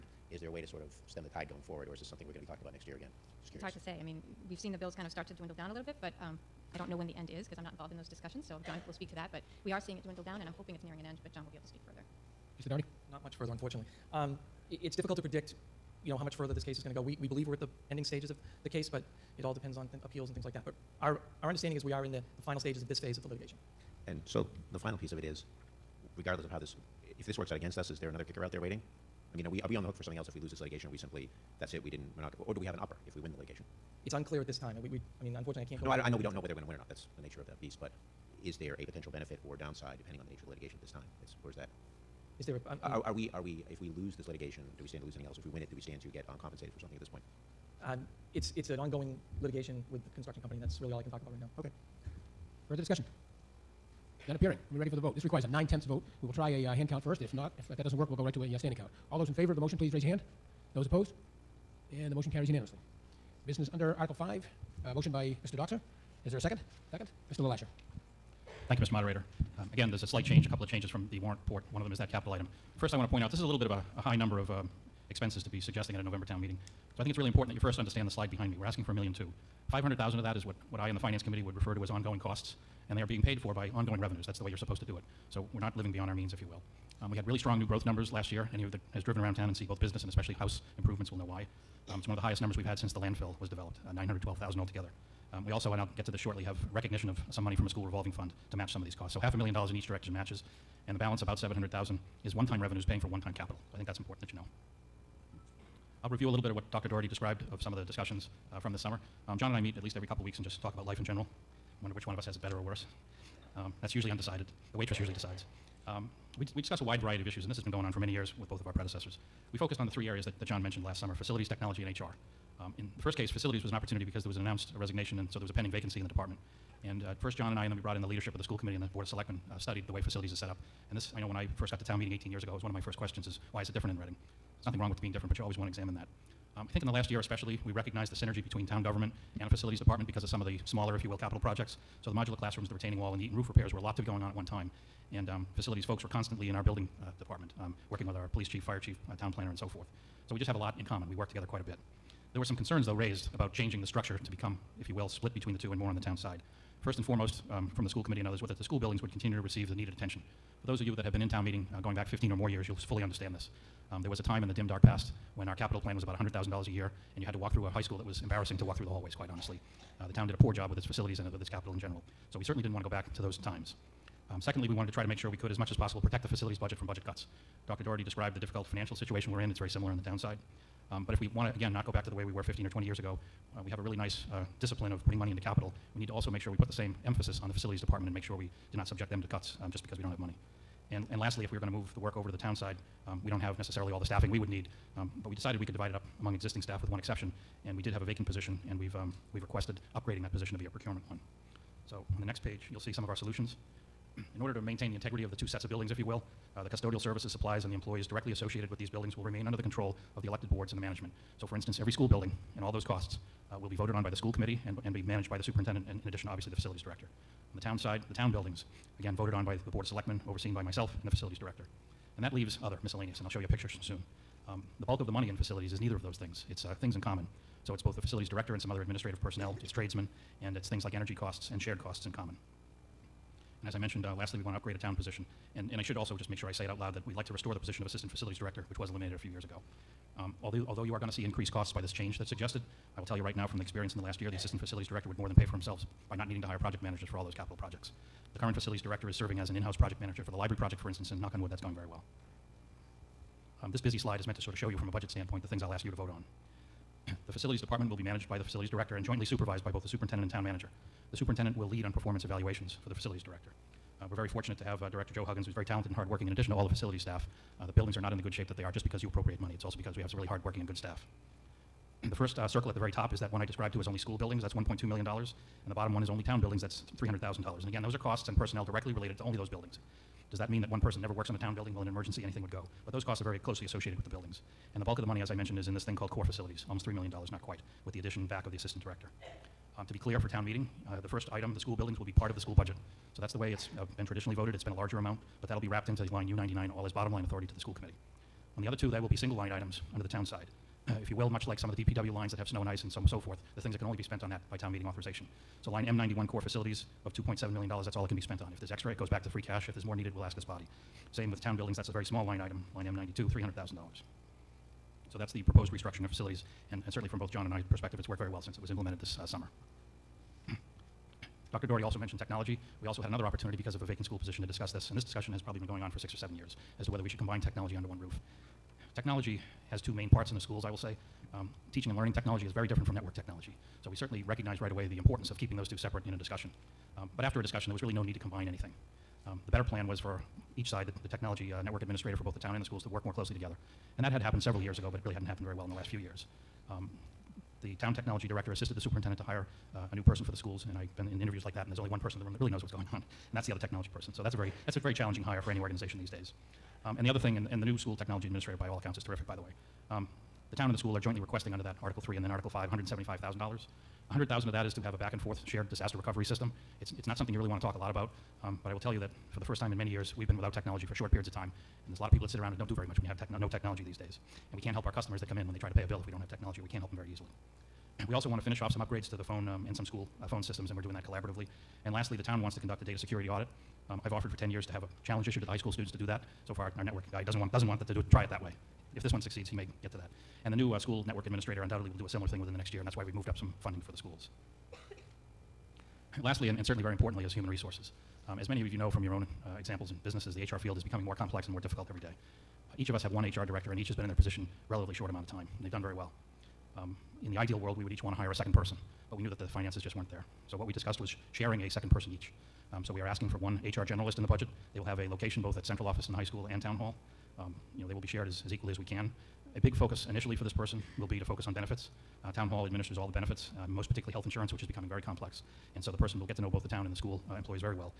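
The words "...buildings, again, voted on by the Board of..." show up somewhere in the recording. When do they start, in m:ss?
3:38.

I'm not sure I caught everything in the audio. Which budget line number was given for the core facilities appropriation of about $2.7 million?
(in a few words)
M91.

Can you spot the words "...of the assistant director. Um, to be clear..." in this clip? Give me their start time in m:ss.
4:48.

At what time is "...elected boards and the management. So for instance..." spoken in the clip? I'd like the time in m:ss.
3:30.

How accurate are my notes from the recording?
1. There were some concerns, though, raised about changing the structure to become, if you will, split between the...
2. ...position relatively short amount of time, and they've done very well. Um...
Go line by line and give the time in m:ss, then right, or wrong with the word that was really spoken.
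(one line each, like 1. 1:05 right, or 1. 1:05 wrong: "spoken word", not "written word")
1. 2:32 right
2. 6:44 right.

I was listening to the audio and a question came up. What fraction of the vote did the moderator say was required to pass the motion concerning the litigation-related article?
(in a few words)
Nine-tenths.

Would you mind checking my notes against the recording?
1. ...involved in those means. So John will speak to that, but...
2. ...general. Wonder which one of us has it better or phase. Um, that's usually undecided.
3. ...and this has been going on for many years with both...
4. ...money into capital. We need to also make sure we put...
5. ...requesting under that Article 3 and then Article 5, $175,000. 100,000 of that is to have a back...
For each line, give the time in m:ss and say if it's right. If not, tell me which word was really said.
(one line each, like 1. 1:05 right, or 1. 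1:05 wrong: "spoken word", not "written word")
1. 0:07 wrong: "discussions", not "means"
2. 1:51 wrong: "worse", not "phase"
3. 1:57 right
4. 3:05 right
5. 6:01 right.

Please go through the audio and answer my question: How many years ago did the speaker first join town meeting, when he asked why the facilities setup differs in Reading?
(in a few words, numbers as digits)
18.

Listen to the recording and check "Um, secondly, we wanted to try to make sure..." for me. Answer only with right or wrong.
right.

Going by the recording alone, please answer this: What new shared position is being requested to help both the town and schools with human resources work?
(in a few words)
HR generalist.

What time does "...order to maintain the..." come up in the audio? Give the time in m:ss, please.
3:24.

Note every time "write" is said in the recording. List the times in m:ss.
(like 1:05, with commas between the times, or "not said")
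not said.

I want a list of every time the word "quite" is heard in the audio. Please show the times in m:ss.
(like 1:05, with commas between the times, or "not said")
2:31, 2:49, 4:47.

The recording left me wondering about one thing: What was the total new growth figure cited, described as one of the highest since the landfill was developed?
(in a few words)
912,000.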